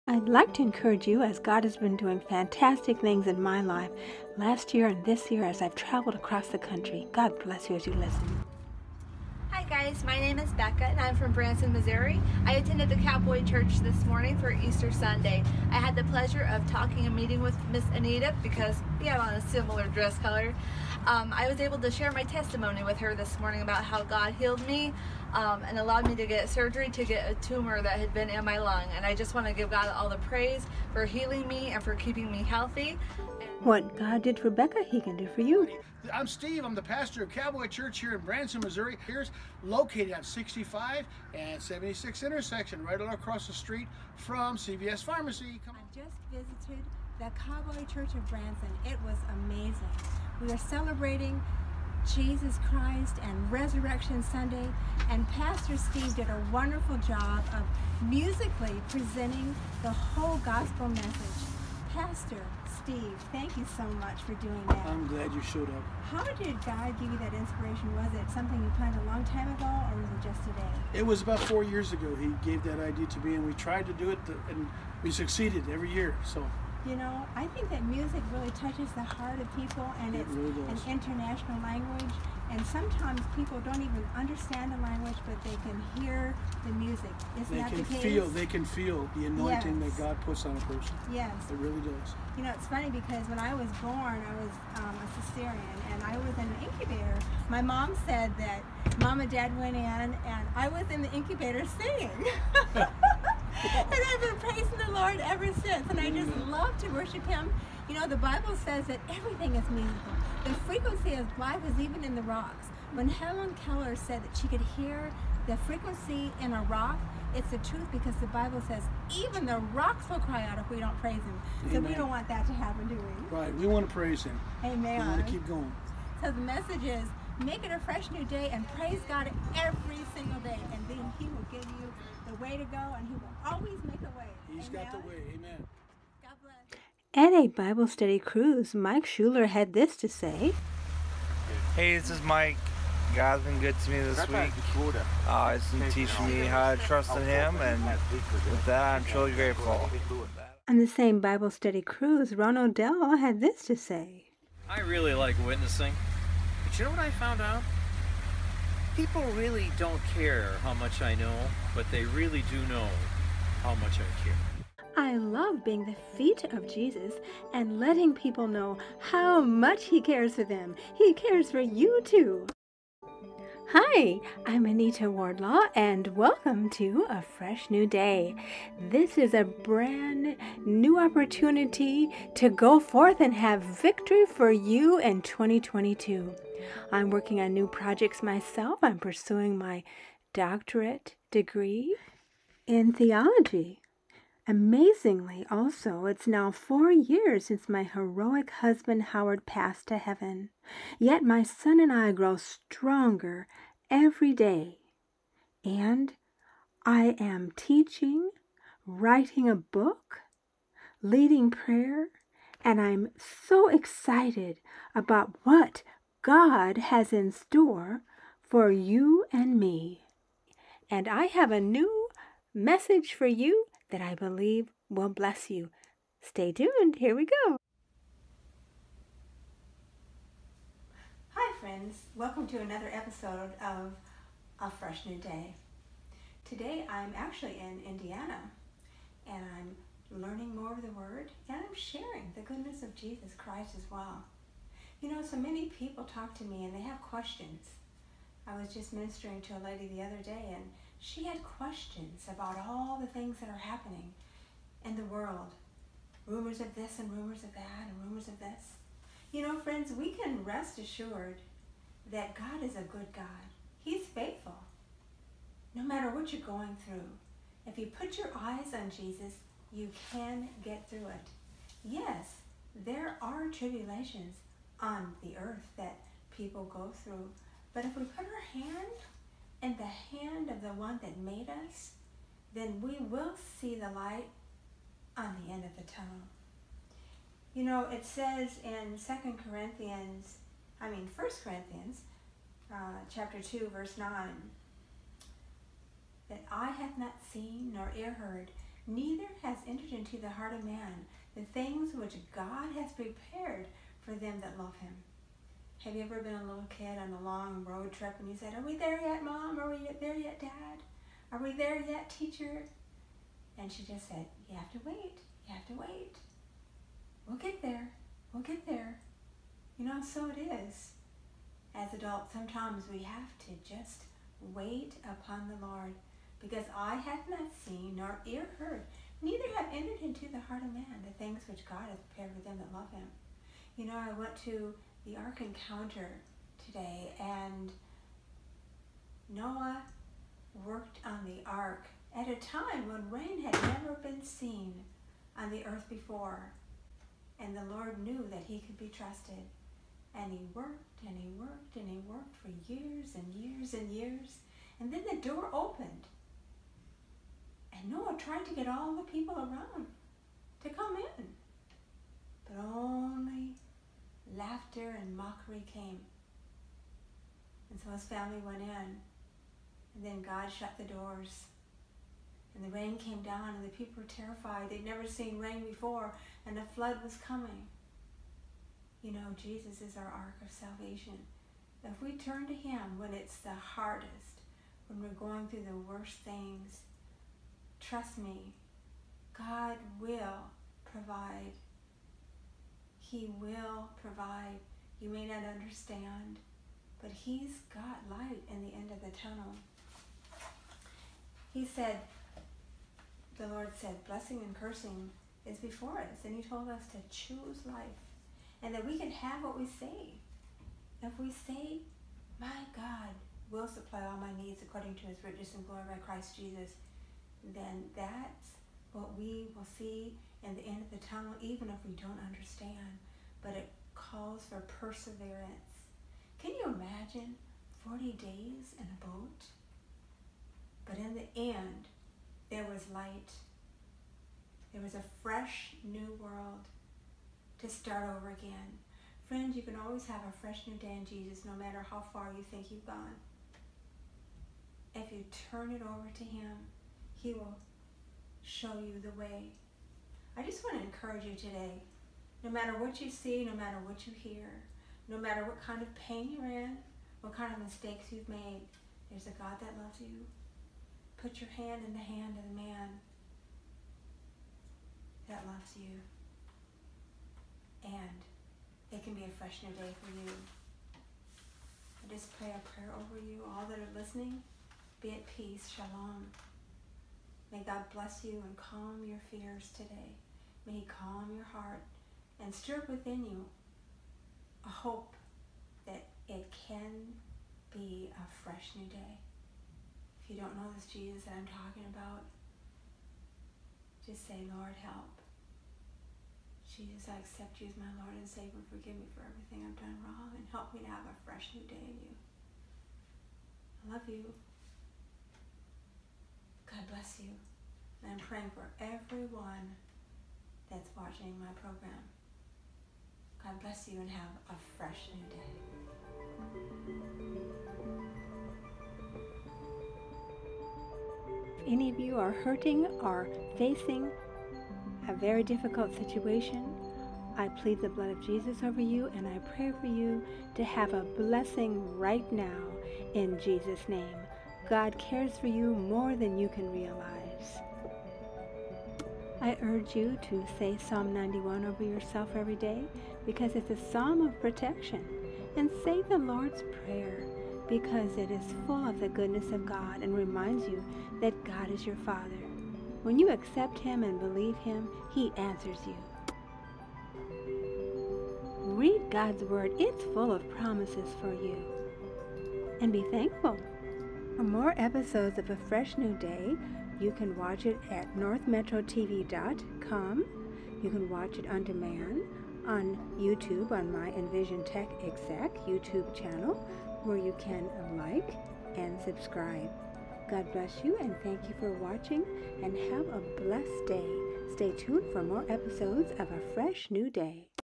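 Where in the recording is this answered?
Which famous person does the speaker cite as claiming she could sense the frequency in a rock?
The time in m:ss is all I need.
1:53.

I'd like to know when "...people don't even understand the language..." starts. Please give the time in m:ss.
1:23.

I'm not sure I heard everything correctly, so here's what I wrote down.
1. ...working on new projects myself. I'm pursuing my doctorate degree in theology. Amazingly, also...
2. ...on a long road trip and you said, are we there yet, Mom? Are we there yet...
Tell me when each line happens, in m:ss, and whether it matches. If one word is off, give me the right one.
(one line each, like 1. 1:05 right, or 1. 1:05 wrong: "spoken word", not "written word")
1. 3:07 right
2. 5:07 right.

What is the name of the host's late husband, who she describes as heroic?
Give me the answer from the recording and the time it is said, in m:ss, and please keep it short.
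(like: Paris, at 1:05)
Howard, at 3:19.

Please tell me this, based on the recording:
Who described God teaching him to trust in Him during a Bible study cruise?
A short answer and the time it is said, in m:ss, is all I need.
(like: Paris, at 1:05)
Mike Schuler, at 2:18.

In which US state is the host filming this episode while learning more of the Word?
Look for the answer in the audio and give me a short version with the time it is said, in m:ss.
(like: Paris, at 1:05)
Indiana, at 3:57.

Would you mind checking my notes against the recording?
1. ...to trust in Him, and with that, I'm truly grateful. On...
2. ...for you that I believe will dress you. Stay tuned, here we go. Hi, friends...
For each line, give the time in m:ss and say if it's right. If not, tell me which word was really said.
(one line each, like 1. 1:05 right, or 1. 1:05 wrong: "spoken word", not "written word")
1. 2:26 right
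2. 3:43 wrong: "bless", not "dress".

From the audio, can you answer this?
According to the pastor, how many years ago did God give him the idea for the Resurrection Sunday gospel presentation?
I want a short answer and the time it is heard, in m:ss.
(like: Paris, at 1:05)
4, at 1:11.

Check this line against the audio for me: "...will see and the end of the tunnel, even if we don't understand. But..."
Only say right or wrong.
right.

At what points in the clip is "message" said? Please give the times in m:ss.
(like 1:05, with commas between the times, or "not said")
1:00, 2:06, 3:42.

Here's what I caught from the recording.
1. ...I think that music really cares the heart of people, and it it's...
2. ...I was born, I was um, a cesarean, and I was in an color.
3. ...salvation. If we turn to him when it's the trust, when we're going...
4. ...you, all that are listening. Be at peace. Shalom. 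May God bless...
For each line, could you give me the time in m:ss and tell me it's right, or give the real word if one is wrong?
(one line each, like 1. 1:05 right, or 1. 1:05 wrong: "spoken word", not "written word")
1. 1:17 wrong: "touches", not "cares"
2. 1:33 wrong: "incubator", not "color"
3. 6:20 wrong: "hardest", not "trust"
4. 7:53 right.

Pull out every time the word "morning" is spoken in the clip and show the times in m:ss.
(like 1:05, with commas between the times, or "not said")
0:14, 0:23.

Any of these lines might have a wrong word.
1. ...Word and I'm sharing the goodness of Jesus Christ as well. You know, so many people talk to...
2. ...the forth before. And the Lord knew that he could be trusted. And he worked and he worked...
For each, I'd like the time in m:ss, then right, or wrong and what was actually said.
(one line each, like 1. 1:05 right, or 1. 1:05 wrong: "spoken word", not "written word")
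1. 4:00 right
2. 5:45 wrong: "earth", not "forth".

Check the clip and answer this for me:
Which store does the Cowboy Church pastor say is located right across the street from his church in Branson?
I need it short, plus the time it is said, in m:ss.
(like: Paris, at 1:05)
CVS Pharmacy, at 0:44.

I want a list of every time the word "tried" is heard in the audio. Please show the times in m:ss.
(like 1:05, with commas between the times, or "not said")
1:13, 5:58.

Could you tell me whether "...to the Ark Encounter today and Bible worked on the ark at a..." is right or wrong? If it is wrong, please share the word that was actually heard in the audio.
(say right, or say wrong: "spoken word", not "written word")
wrong: "Noah", not "Bible".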